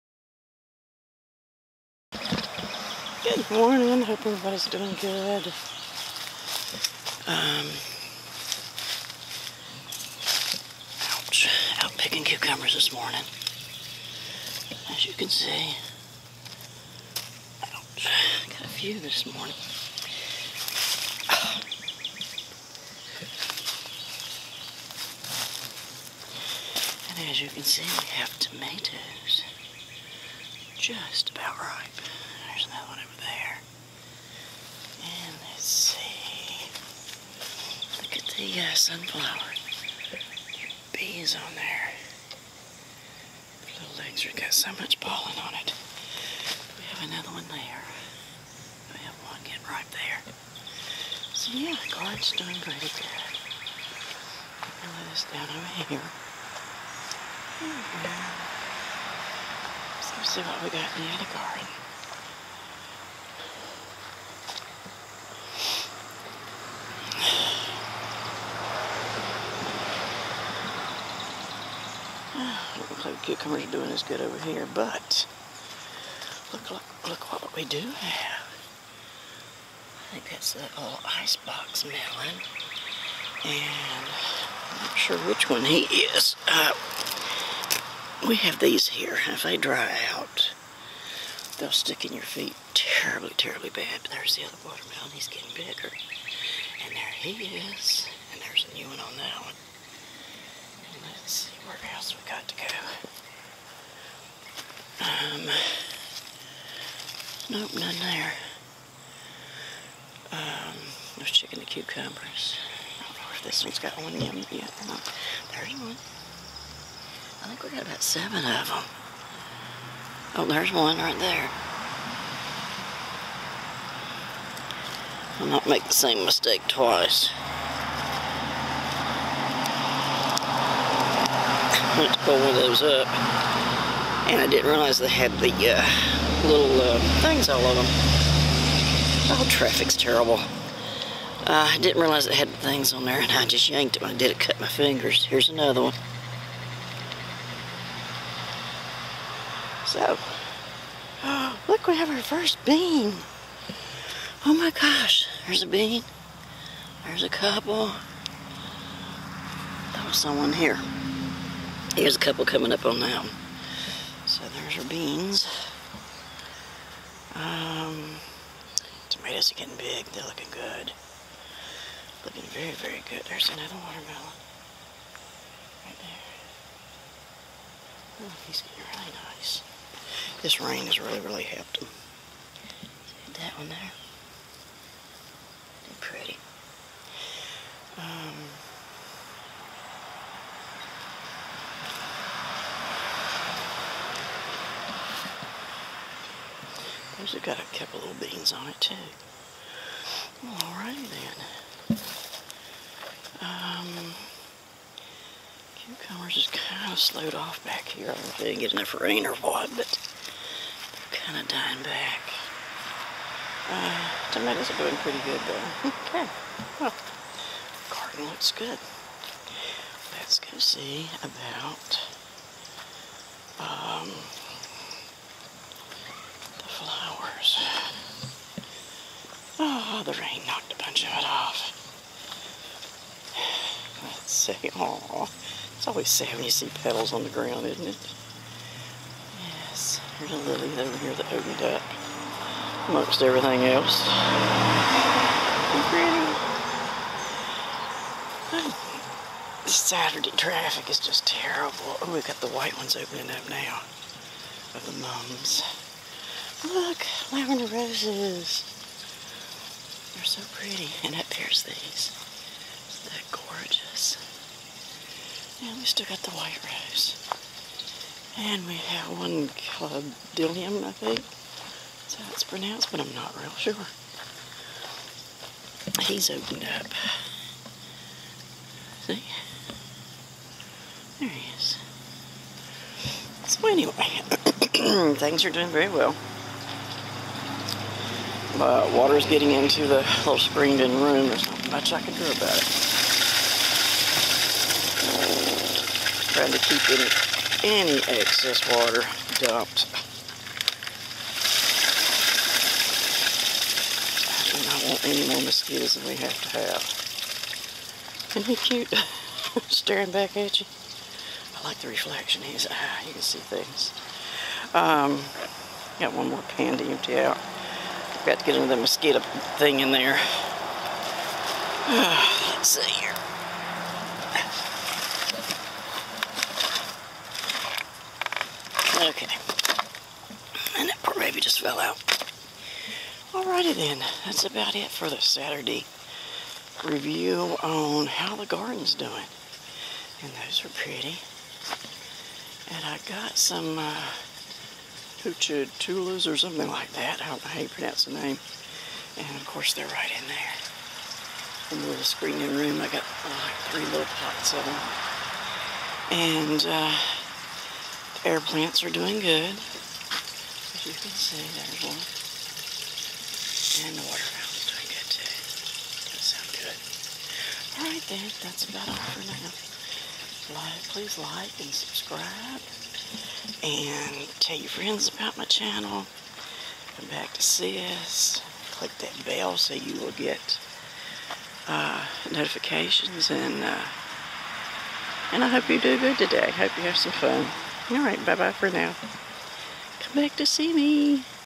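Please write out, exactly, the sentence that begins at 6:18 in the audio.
Click that bell so you will get uh, notifications.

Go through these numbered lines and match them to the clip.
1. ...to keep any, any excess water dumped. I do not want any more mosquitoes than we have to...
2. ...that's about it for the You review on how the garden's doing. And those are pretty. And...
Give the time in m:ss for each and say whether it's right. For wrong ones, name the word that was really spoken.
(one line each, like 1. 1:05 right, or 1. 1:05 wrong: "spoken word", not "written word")
1. 4:56 right
2. 5:34 wrong: "Saturday", not "You".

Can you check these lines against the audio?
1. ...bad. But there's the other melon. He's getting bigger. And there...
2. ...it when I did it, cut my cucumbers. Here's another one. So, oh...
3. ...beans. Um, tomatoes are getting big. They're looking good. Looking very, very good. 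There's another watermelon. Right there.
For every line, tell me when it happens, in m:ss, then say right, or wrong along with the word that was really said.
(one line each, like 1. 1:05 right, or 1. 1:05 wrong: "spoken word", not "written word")
1. 1:33 wrong: "watermelon", not "melon"
2. 2:23 wrong: "fingers", not "cucumbers"
3. 2:44 right.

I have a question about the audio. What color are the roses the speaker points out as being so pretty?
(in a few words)
lavender.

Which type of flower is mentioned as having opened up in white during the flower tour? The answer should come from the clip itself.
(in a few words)
mums.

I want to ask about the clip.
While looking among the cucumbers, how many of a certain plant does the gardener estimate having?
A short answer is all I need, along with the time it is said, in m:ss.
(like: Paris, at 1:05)
7, at 1:58.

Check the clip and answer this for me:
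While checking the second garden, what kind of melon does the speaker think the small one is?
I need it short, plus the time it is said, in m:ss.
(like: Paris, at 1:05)
icebox melon, at 1:21.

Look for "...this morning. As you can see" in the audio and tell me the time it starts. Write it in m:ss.
0:12.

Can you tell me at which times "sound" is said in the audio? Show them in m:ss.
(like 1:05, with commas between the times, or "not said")
6:06.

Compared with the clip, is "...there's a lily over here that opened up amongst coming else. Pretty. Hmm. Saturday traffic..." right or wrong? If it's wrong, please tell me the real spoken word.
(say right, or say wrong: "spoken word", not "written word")
wrong: "everything", not "coming".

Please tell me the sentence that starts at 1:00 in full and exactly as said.
So let's see what we got in the other garden.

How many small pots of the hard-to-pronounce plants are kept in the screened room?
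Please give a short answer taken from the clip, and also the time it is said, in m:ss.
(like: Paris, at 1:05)
3, at 5:53.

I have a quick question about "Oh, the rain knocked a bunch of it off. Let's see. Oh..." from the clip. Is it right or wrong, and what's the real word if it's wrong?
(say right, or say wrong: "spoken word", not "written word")
right.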